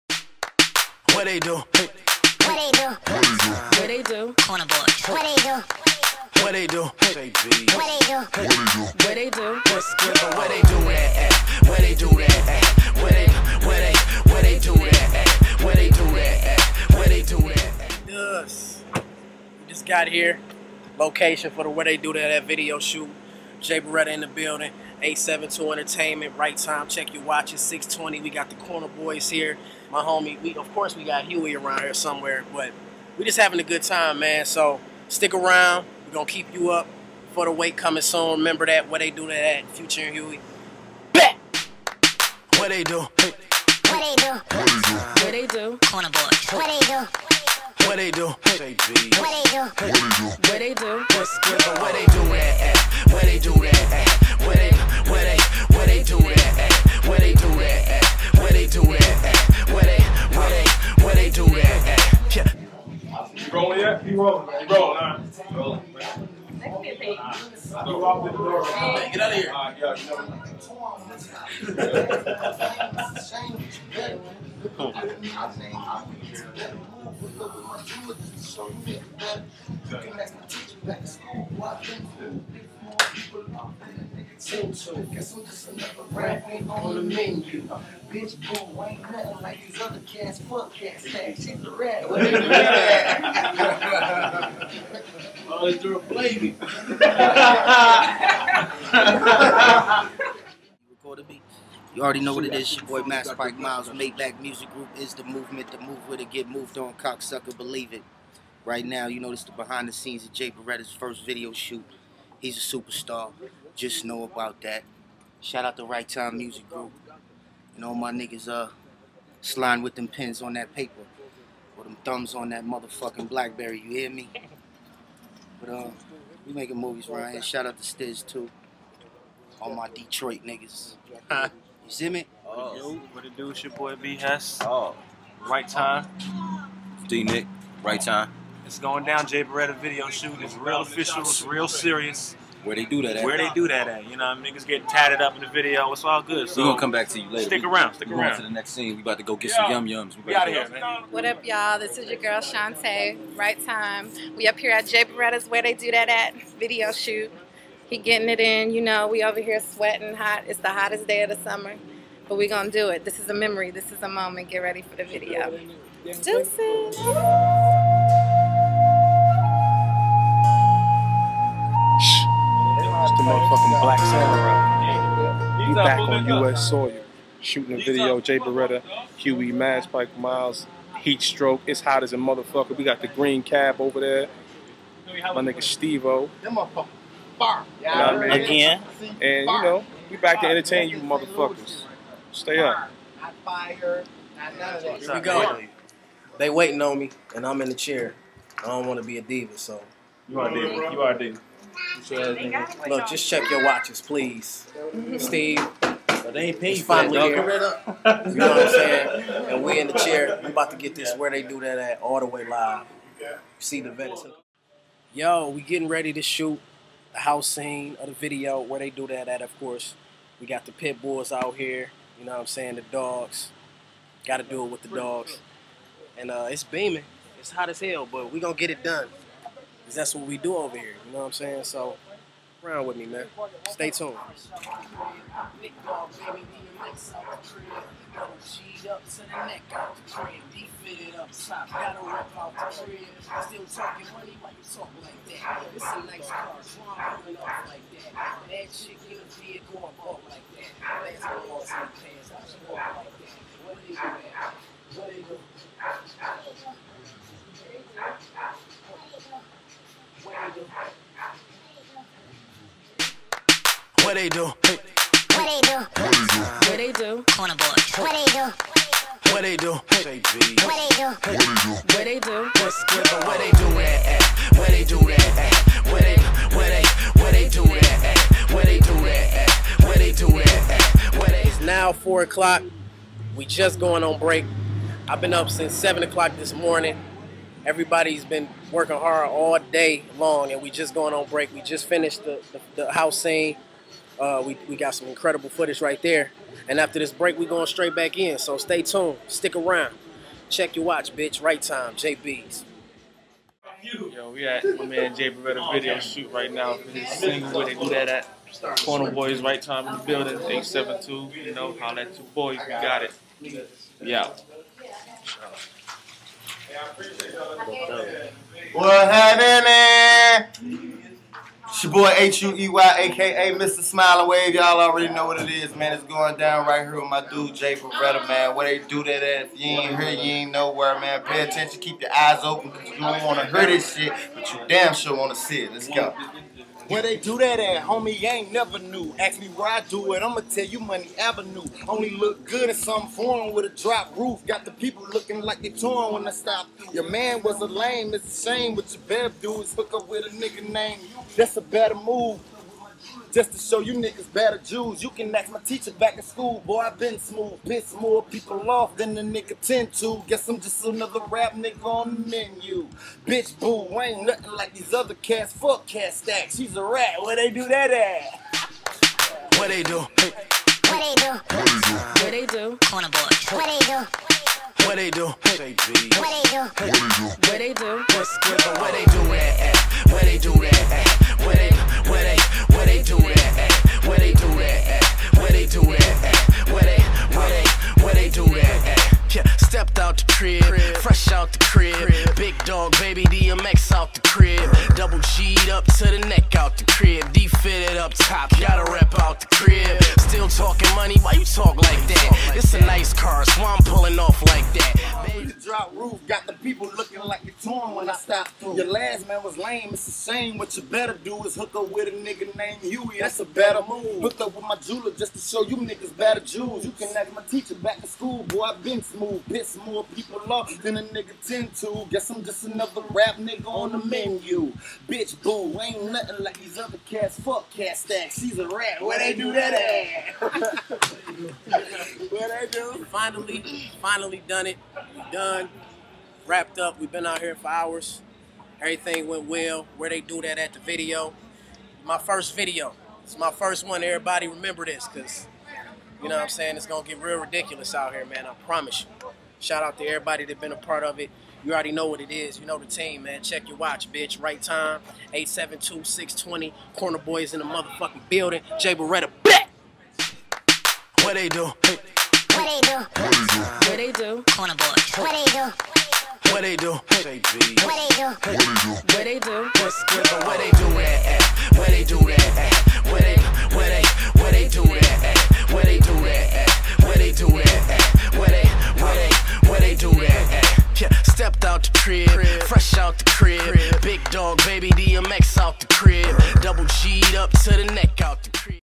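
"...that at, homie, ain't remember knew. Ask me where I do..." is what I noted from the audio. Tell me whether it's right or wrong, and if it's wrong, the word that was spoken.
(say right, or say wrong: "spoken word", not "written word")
wrong: "never", not "remember".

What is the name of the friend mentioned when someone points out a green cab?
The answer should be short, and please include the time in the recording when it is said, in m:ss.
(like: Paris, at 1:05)
Steve-O, at 3:05.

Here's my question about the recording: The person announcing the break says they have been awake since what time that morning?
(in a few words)
7 o'clock.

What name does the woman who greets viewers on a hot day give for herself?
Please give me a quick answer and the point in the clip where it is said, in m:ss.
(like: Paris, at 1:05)
Shantae, at 2:32.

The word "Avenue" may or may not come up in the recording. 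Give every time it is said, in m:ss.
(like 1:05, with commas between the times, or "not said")
5:41.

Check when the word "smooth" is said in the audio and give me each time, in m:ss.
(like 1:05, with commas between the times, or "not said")
5:57, 6:59.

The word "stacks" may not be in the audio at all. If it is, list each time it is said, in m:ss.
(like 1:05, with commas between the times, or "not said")
1:31, 6:06, 7:07.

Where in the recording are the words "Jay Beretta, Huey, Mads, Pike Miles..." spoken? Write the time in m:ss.
2:58.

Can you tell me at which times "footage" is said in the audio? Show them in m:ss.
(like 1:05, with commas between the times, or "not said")
4:55.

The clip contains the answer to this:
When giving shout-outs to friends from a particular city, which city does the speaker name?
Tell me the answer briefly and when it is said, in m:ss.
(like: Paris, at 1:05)
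Detroit, at 2:09.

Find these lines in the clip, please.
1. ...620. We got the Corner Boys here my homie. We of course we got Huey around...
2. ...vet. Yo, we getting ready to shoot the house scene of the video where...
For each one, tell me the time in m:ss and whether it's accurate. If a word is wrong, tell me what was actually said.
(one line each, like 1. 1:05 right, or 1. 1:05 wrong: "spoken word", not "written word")
1. 0:27 right
2. 3:33 right.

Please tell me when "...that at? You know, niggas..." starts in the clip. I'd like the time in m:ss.
2:23.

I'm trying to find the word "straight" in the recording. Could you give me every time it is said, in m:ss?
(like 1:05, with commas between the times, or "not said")
4:57.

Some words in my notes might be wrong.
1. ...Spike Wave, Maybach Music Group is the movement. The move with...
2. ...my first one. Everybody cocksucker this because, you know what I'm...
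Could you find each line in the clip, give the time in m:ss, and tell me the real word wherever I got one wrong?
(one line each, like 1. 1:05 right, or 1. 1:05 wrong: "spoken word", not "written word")
1. 1:43 wrong: "Miles", not "Wave"
2. 7:23 wrong: "remember", not "cocksucker".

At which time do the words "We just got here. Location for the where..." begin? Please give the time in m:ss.
0:18.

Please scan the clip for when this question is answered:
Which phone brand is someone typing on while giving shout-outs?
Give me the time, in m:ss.
2:03.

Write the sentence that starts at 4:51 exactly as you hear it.
We just finished the, the, the house scene.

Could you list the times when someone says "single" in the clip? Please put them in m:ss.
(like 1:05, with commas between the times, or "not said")
5:07.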